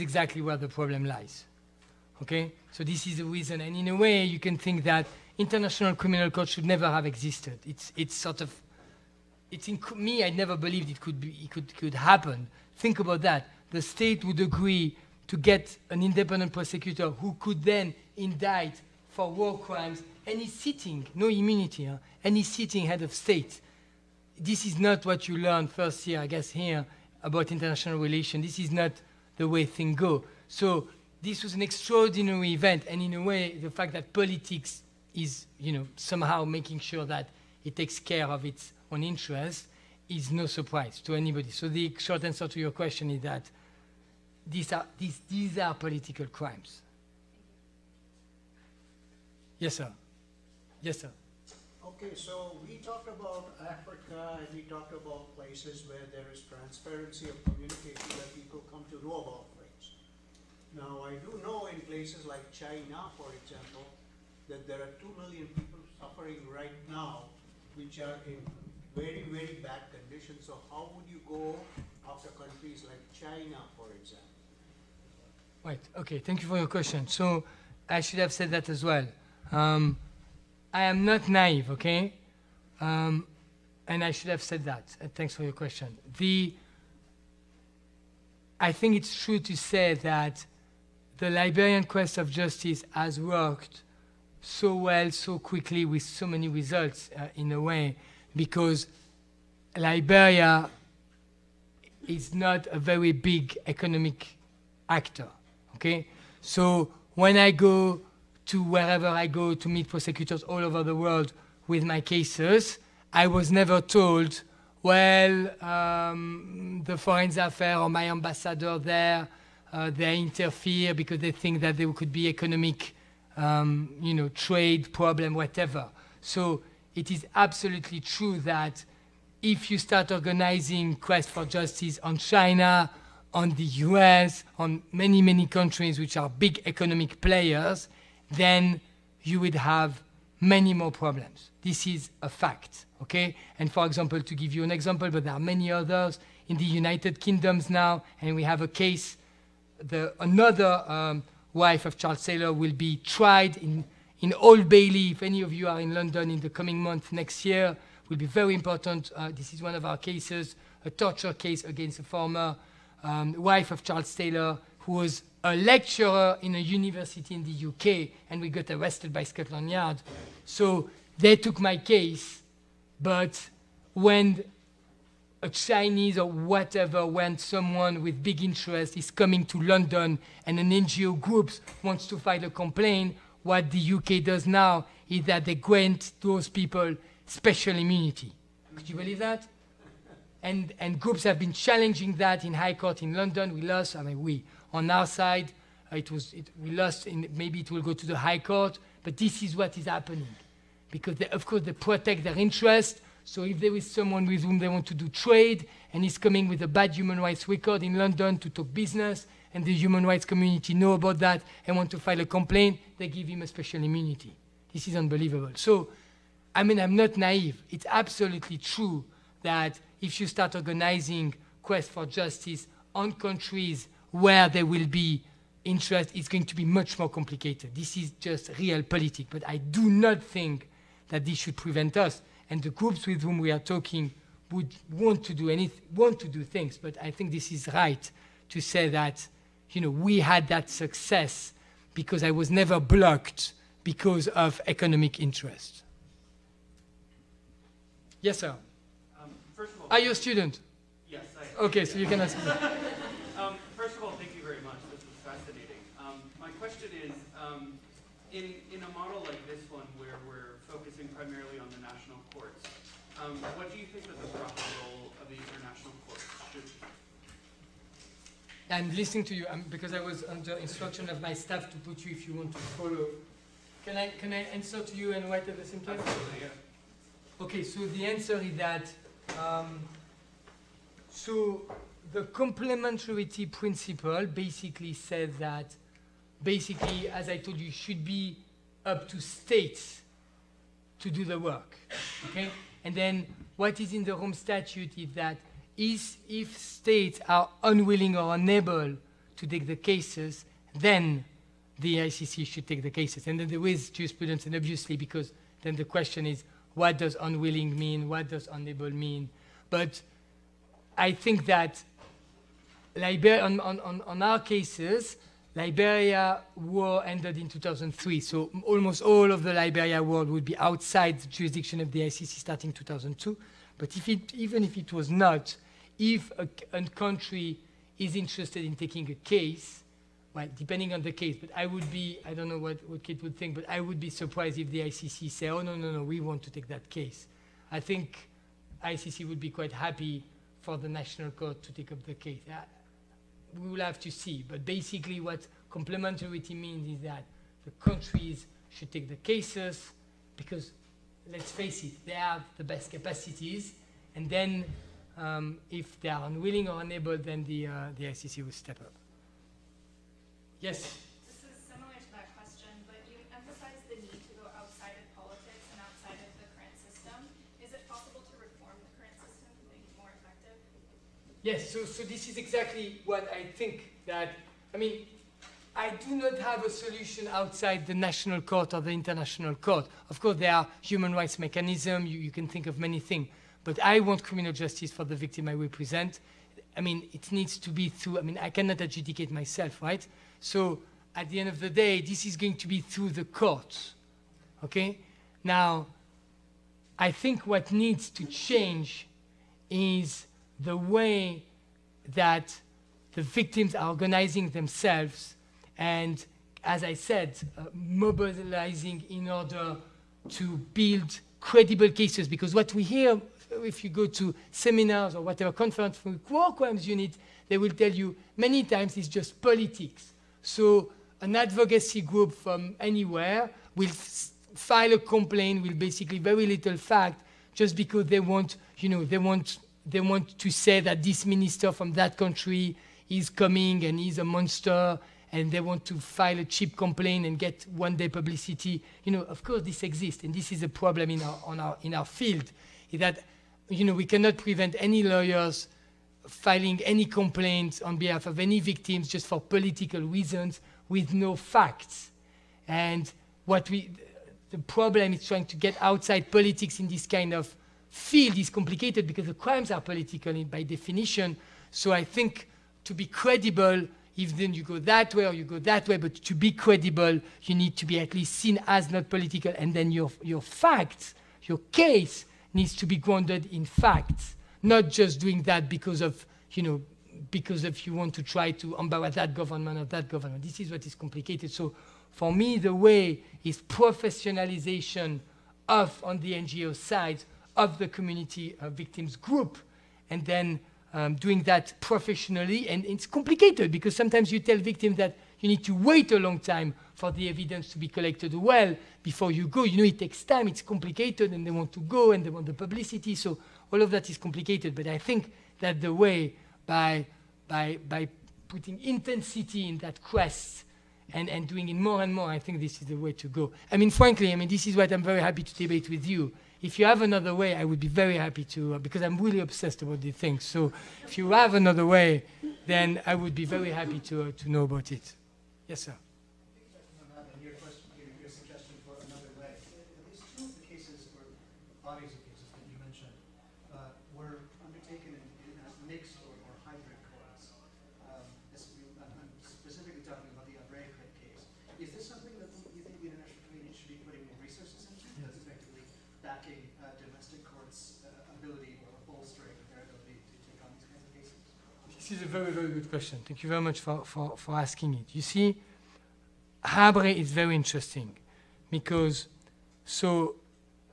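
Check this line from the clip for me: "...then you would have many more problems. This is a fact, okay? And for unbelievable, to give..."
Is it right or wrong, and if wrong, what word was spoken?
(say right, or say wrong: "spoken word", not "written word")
wrong: "example", not "unbelievable".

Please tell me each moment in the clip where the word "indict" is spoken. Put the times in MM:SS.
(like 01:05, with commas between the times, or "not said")
00:18.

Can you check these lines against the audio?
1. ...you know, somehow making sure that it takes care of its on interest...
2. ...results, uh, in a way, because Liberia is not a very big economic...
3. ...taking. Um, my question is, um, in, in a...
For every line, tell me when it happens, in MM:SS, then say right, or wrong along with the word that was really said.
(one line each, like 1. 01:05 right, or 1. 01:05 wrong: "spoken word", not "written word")
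1. 00:35 right
2. 01:36 right
3. 04:15 wrong: "fascinating", not "taking".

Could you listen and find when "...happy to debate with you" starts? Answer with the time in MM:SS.
08:35.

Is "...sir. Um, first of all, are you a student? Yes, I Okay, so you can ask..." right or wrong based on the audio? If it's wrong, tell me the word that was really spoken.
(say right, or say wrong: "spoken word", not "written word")
right.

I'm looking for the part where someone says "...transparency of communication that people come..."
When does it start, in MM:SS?
00:56.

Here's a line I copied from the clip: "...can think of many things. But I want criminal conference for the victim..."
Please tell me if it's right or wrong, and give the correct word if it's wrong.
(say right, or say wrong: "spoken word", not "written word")
wrong: "justice", not "conference".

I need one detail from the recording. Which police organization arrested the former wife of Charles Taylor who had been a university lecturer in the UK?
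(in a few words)
Scotland Yard.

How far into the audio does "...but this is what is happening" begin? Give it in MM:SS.
03:19.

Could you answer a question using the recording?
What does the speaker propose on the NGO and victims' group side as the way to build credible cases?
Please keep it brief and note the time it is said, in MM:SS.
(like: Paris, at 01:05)
professionalization, at 08:03.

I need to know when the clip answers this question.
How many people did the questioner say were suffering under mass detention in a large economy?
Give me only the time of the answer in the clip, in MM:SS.
01:05.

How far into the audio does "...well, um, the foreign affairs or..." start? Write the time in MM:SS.
01:54.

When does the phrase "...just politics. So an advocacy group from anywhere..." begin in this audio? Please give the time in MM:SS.
06:59.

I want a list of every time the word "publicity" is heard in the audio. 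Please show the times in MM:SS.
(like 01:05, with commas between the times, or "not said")
07:18, 08:22.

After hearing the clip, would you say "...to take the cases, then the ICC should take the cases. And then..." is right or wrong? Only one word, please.
right.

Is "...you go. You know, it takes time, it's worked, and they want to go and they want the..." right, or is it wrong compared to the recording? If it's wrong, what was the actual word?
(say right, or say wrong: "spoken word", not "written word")
wrong: "complicated", not "worked".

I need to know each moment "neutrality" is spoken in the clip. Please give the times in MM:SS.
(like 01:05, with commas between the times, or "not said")
not said.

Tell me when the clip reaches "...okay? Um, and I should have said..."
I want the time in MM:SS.
01:21.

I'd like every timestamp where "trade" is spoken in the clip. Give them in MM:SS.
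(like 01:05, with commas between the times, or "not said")
02:04, 03:25.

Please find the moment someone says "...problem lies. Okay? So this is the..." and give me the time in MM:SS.
00:00.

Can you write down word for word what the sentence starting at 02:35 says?
If any of you are in London in the coming month next year, will be very important.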